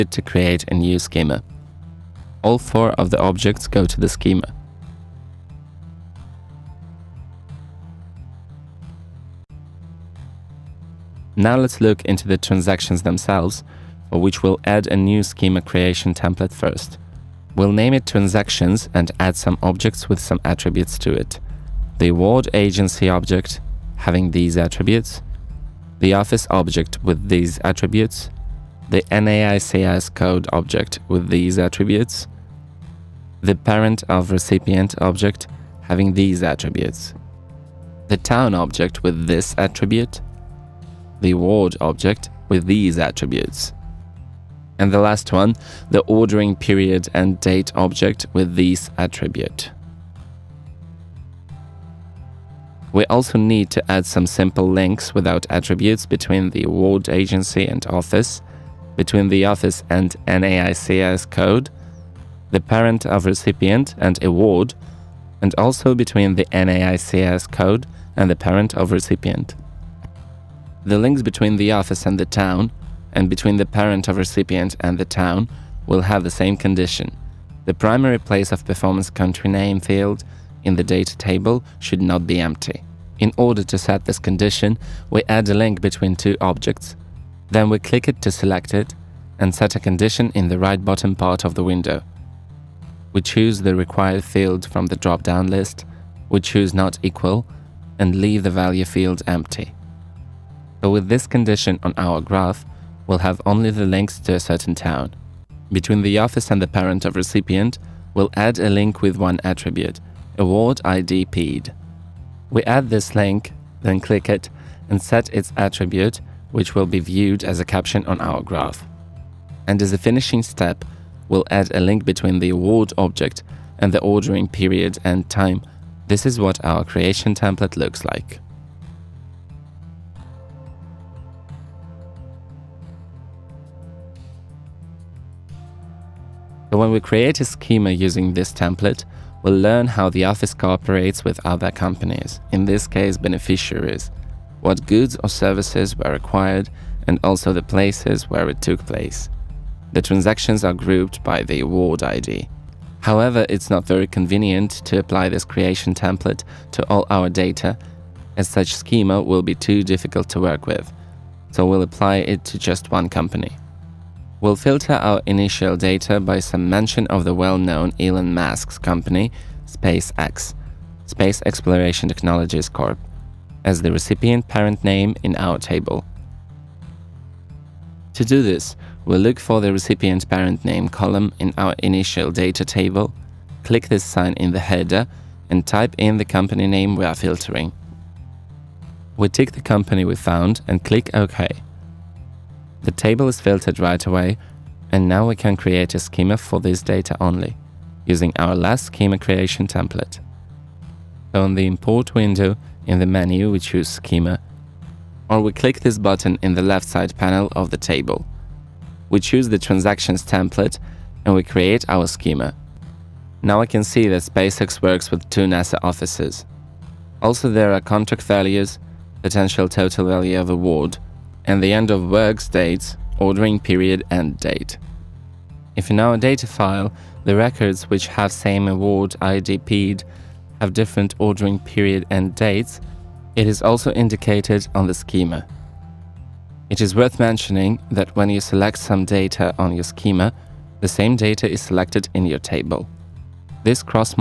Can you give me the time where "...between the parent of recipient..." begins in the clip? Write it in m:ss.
1:13.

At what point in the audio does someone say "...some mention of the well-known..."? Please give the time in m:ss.
2:46.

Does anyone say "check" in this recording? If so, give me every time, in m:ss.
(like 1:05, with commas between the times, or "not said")
not said.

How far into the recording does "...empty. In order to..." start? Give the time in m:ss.
1:22.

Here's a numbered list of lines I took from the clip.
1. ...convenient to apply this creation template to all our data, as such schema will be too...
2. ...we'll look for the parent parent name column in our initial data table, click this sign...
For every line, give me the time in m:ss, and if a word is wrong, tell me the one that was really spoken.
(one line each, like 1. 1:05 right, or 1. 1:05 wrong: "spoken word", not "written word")
1. 2:34 right
2. 2:59 wrong: "recipient", not "parent".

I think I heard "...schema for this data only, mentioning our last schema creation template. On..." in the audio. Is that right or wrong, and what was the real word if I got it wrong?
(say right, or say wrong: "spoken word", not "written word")
wrong: "using", not "mentioning".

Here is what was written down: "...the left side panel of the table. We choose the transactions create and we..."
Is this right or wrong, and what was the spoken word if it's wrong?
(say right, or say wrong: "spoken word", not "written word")
wrong: "template", not "create".